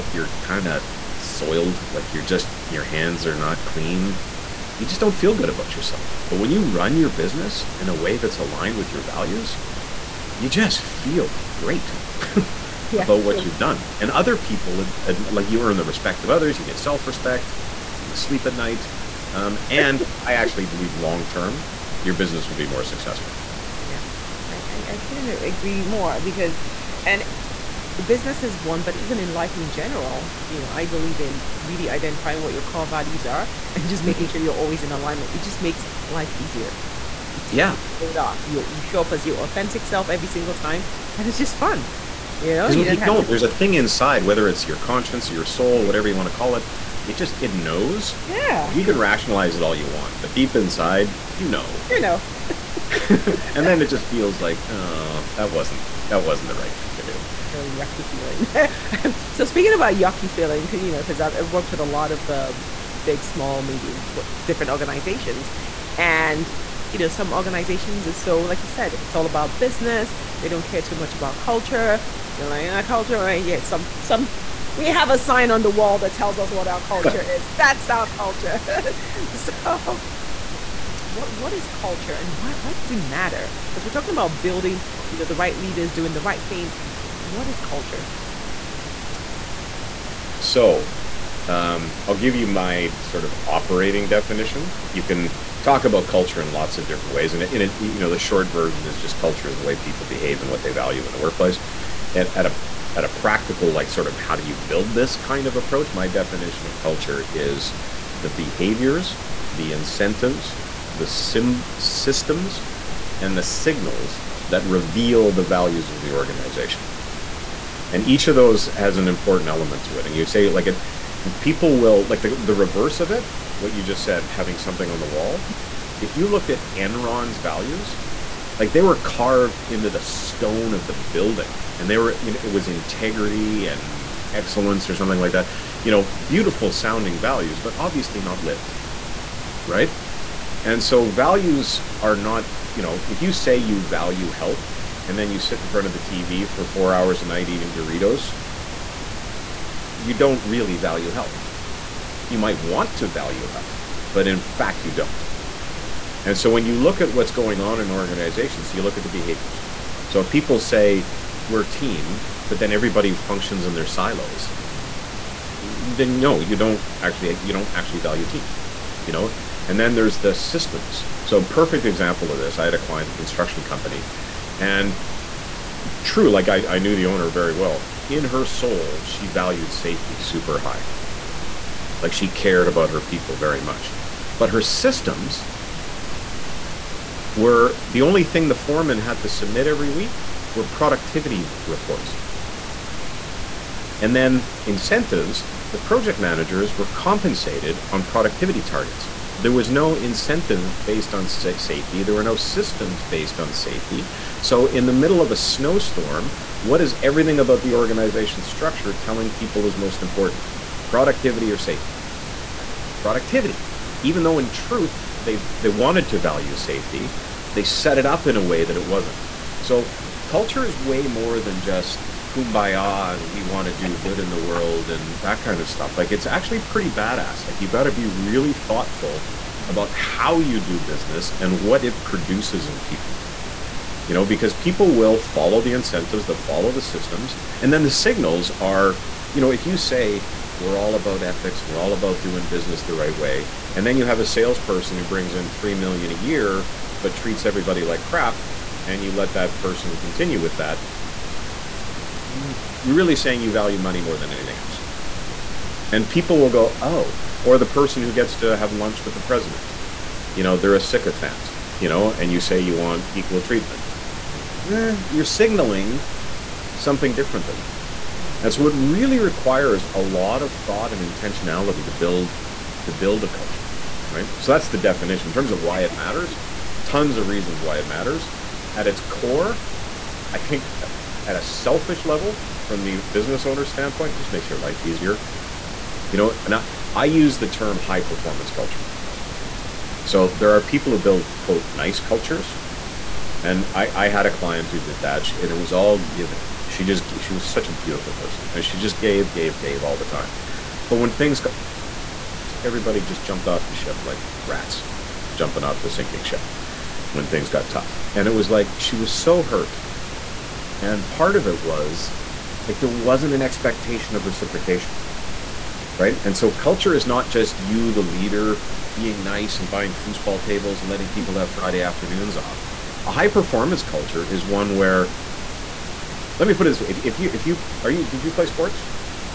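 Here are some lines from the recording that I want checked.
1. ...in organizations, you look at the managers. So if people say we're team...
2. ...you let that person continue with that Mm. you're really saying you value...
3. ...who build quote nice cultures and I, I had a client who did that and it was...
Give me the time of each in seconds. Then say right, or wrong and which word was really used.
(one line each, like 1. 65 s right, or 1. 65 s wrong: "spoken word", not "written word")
1. 157 s wrong: "behaviors", not "managers"
2. 249 s right
3. 290 s right.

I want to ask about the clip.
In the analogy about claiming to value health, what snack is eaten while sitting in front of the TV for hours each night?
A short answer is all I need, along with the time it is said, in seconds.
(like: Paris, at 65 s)
Doritos, at 147 s.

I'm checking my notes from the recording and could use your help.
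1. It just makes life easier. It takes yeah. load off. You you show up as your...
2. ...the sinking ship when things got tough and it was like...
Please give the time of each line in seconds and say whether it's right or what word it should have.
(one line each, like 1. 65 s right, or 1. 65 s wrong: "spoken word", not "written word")
1. 35 s right
2. 305 s right.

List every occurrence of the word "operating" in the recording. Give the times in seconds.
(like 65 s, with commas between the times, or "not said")
93 s.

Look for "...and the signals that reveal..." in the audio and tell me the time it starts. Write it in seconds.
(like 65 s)
113 s.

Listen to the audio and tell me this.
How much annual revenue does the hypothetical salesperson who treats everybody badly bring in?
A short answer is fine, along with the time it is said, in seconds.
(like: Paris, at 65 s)
3 million, at 245 s.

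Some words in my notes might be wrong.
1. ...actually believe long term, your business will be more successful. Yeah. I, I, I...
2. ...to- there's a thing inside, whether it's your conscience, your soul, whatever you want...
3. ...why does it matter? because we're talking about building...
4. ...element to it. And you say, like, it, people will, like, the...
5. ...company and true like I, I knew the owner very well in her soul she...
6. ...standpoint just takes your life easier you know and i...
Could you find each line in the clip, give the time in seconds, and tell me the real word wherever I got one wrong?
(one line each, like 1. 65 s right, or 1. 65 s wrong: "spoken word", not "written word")
1. 20 s right
2. 42 s right
3. 82 s right
4. 119 s right
5. 173 s right
6. 283 s wrong: "makes", not "takes".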